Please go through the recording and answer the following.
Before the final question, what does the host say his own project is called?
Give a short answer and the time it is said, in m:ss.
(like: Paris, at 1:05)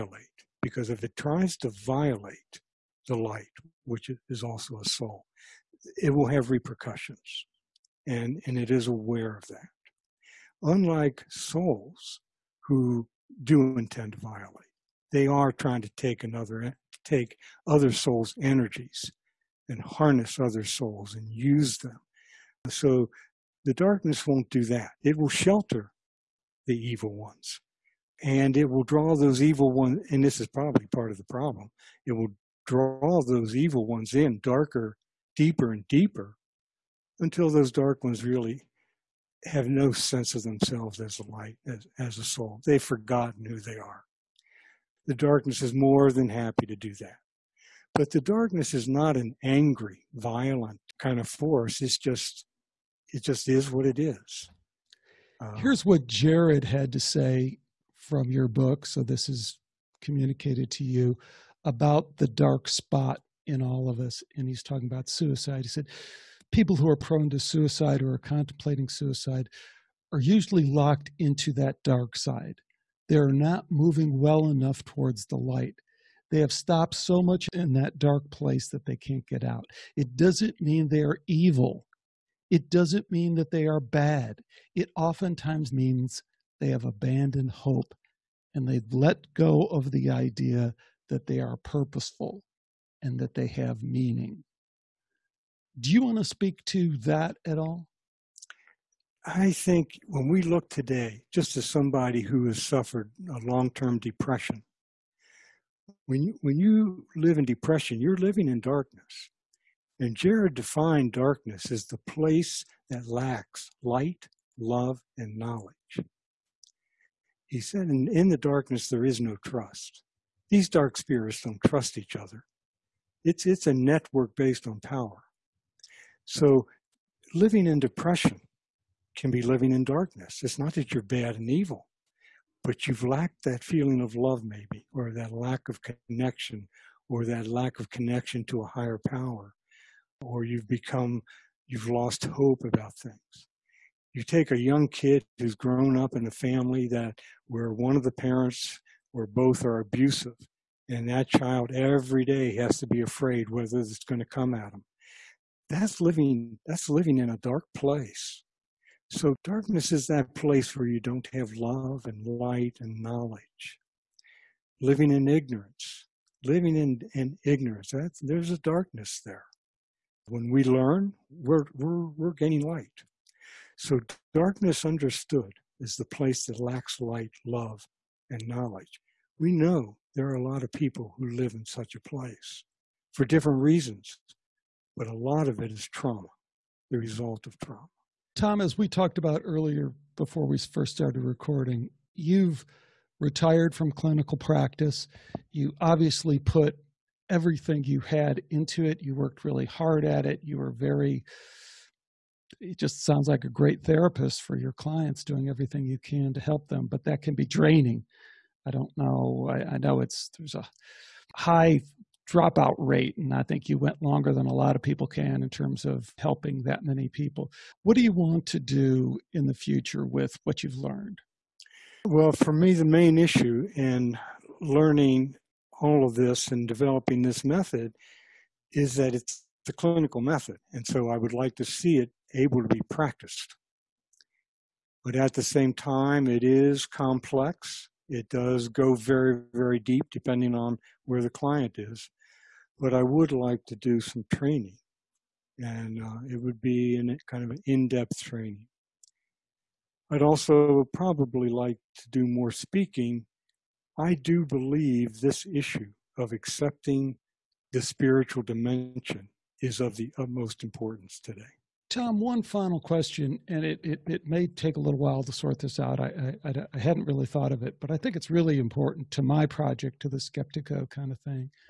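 Skeptiko, at 4:30.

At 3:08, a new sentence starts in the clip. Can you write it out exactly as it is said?
Tom, as we talked about earlier before we first started recording, you've retired from clinical practice.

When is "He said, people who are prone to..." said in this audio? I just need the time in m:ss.
1:05.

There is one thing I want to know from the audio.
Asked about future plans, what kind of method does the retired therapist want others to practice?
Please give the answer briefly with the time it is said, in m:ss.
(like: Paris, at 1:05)
clinical method, at 3:49.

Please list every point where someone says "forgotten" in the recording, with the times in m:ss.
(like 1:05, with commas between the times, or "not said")
0:42.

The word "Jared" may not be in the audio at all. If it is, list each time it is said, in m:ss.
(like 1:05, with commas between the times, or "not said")
0:56, 1:50.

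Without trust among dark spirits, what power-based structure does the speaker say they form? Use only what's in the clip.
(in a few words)
network.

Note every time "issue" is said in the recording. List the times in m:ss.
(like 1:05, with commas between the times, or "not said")
3:43, 4:15.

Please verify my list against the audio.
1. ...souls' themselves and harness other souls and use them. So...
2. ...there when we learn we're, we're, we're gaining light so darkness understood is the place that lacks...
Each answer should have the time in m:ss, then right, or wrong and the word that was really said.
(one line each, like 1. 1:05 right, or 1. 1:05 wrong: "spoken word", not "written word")
1. 0:17 wrong: "energies", not "themselves"
2. 2:49 right.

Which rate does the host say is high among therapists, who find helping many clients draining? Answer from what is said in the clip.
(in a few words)
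dropout rate.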